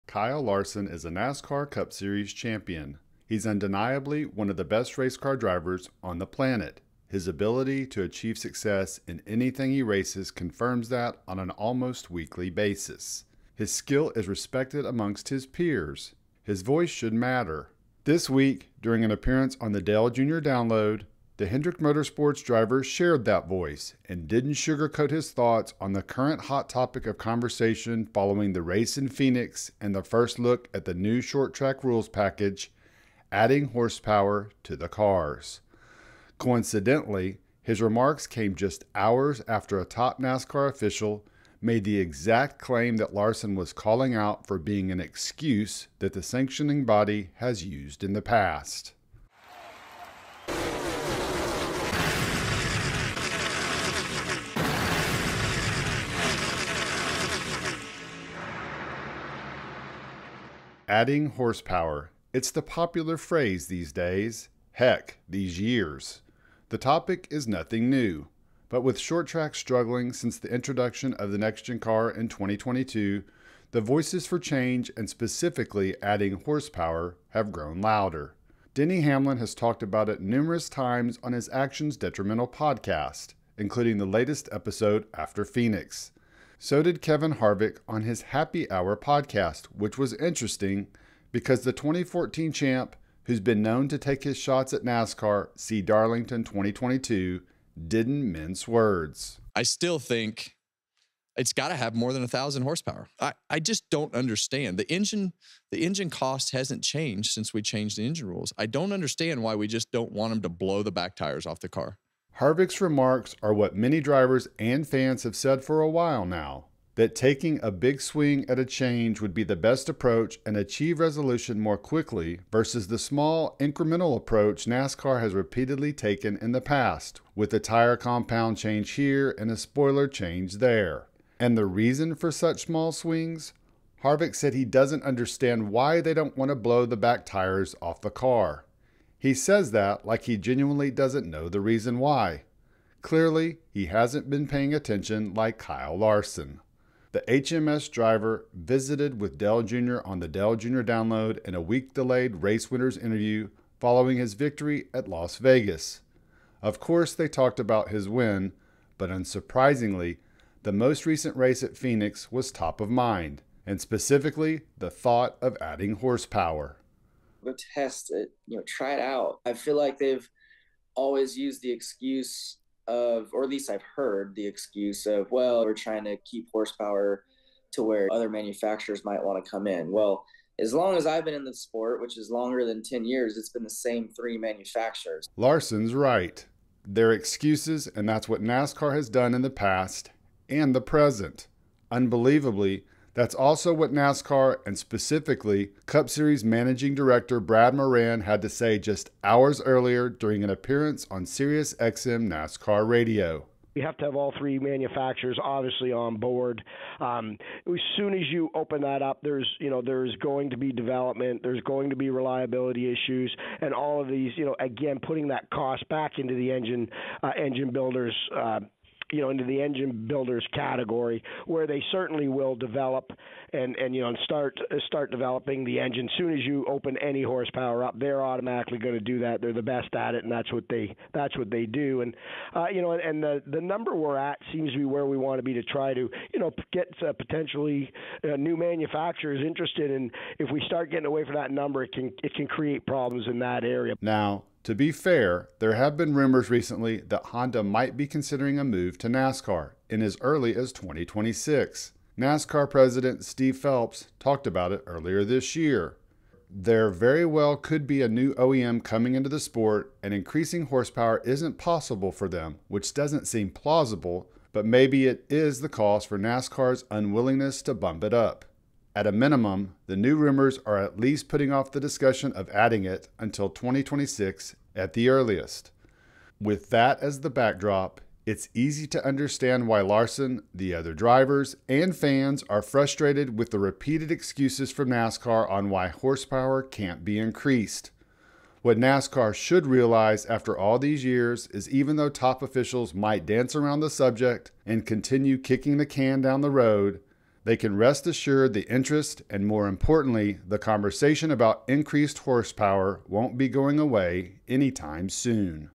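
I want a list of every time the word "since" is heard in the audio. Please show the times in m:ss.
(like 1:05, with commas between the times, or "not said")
1:10, 1:47.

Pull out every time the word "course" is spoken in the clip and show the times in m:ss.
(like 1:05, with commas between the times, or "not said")
2:36.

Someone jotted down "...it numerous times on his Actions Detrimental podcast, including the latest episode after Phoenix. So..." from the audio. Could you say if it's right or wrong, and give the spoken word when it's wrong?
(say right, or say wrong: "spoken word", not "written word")
right.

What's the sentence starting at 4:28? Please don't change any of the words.
At a minimum, the new rumors are at least putting off the discussion of adding it until 2026 at the earliest.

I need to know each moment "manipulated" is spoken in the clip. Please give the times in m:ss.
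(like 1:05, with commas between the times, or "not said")
not said.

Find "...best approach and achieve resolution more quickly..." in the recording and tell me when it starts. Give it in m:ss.
1:59.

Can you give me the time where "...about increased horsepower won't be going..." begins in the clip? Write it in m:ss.
5:01.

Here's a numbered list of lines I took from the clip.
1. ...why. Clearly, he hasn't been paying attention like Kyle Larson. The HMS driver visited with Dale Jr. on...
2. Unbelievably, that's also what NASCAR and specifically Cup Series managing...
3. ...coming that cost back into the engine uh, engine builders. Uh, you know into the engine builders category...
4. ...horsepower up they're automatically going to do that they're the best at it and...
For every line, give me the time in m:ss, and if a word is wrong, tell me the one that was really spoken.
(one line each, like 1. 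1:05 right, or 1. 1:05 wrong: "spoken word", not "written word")
1. 2:21 right
2. 3:11 right
3. 3:35 wrong: "putting", not "coming"
4. 3:47 right.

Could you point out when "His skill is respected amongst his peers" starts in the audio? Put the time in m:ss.
0:13.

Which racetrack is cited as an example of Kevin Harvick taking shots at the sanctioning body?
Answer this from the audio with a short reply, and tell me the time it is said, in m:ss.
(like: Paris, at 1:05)
Darlington, at 1:35.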